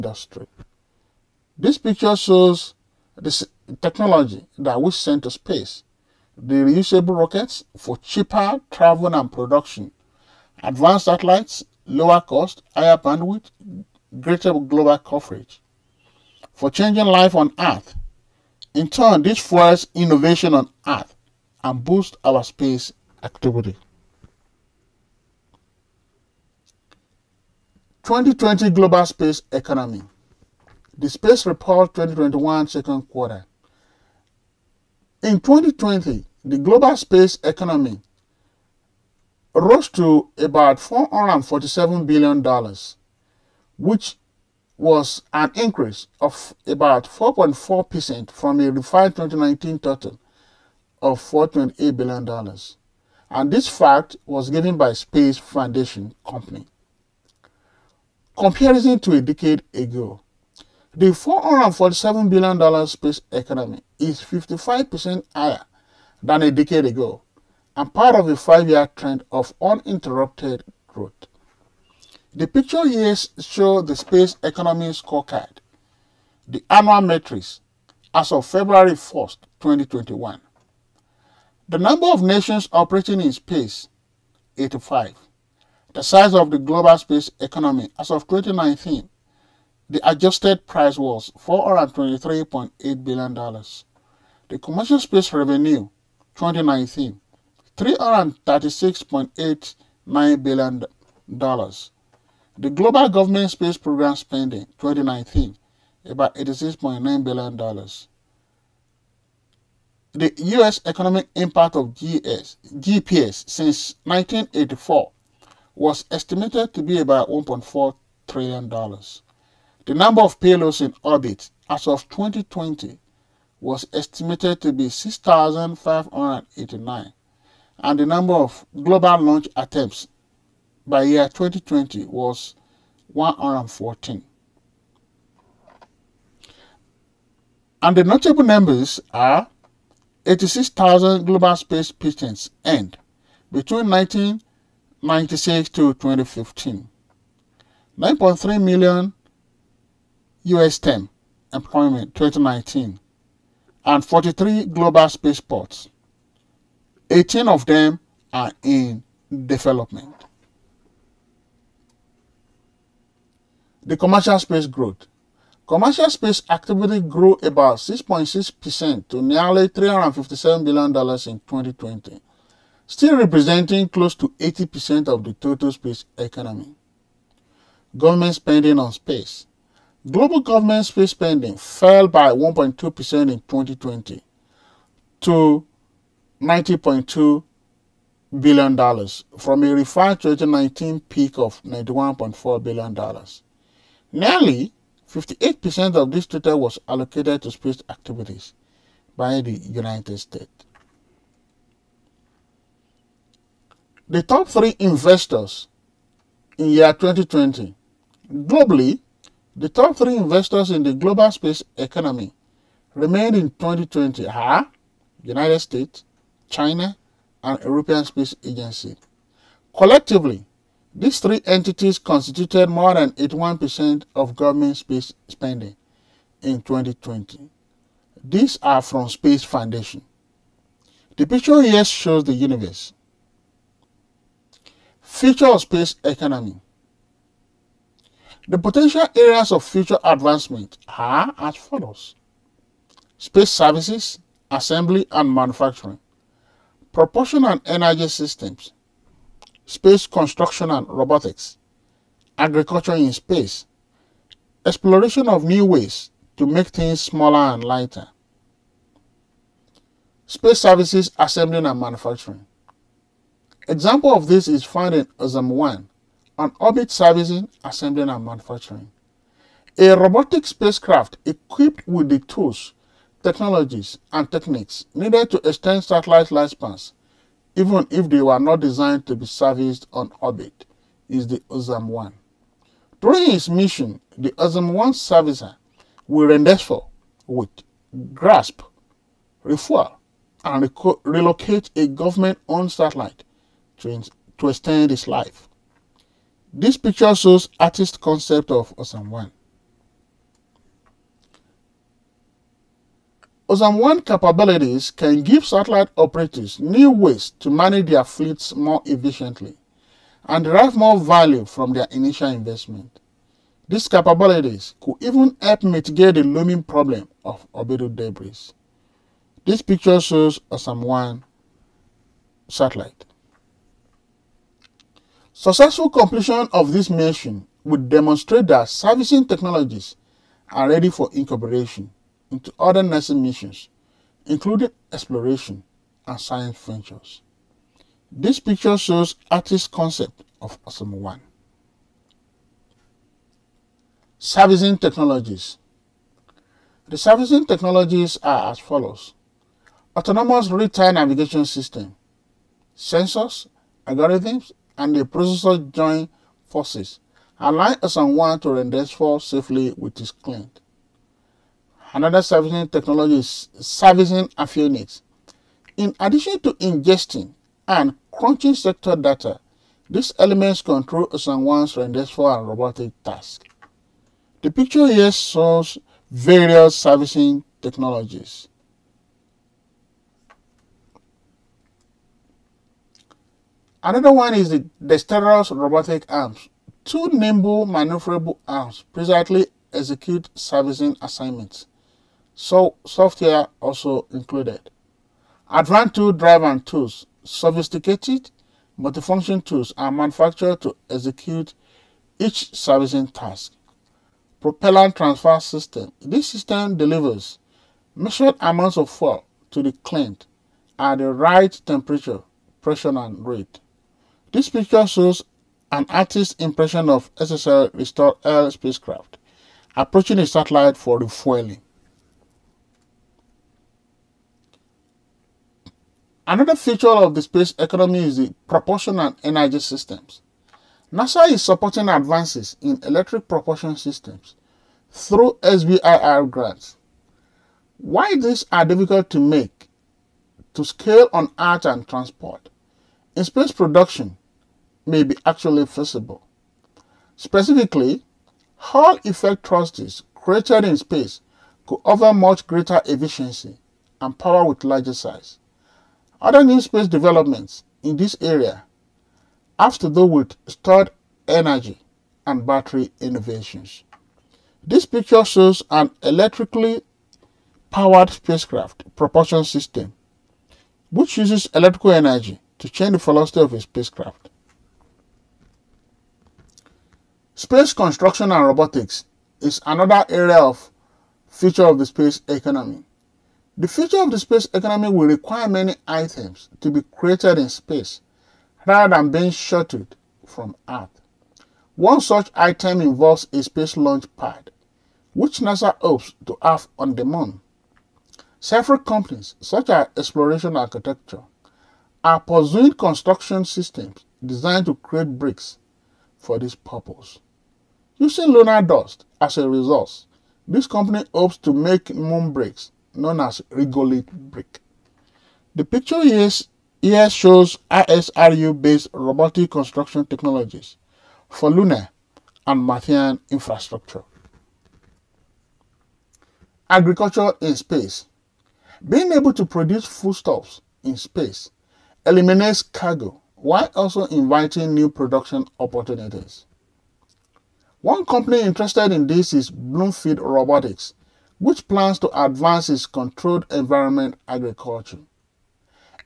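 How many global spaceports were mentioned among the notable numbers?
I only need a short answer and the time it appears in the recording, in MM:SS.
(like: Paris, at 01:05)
43, at 02:34.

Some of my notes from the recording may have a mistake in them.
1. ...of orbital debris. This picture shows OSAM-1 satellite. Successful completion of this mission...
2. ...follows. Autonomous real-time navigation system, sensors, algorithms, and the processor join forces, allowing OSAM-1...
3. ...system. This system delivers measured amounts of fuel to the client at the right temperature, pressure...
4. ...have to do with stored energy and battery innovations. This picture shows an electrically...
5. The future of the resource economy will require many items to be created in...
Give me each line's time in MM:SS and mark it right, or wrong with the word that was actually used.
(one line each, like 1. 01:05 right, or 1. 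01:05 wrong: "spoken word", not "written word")
1. 05:17 right
2. 05:48 right
3. 06:45 right
4. 07:39 right
5. 08:03 wrong: "space", not "resource".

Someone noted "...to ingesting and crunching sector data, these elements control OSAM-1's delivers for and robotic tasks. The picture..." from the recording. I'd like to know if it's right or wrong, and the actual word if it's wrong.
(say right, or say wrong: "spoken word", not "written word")
wrong: "renders", not "delivers".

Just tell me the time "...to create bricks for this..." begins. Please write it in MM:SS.
08:24.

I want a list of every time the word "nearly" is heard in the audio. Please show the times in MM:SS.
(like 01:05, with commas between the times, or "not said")
02:49, 03:14.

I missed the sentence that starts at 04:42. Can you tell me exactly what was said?
During its mission, the OSAM-1 servicer will rendezvous, with grasp, refuel, and relocate a government owned satellite to, to extend his life.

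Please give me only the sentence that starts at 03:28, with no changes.
Globally, the top three investors in the global space economy remained in 2020 are United States, China, and European Space Agency.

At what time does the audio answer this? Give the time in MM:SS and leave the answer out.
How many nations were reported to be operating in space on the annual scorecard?
01:24.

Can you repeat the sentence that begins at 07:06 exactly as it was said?
Another feature of the space economy is the propulsion and energy systems.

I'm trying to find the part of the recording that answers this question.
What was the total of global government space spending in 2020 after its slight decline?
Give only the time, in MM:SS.
03:06.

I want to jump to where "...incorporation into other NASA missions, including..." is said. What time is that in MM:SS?
05:31.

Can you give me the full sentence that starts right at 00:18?
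In turn, this fuels innovation on Earth and boosts our space activity.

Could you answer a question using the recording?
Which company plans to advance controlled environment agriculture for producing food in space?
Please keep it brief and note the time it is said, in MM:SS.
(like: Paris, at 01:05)
Bloomfield Robotics, at 08:59.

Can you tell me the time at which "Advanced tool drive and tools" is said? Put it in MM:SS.
06:35.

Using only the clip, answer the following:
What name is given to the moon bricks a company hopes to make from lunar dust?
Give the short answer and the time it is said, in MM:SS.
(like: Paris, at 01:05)
regolith brick, at 08:33.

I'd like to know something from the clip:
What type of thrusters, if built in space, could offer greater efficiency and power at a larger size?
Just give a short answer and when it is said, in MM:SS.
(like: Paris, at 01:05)
Hall effect thrusters, at 07:28.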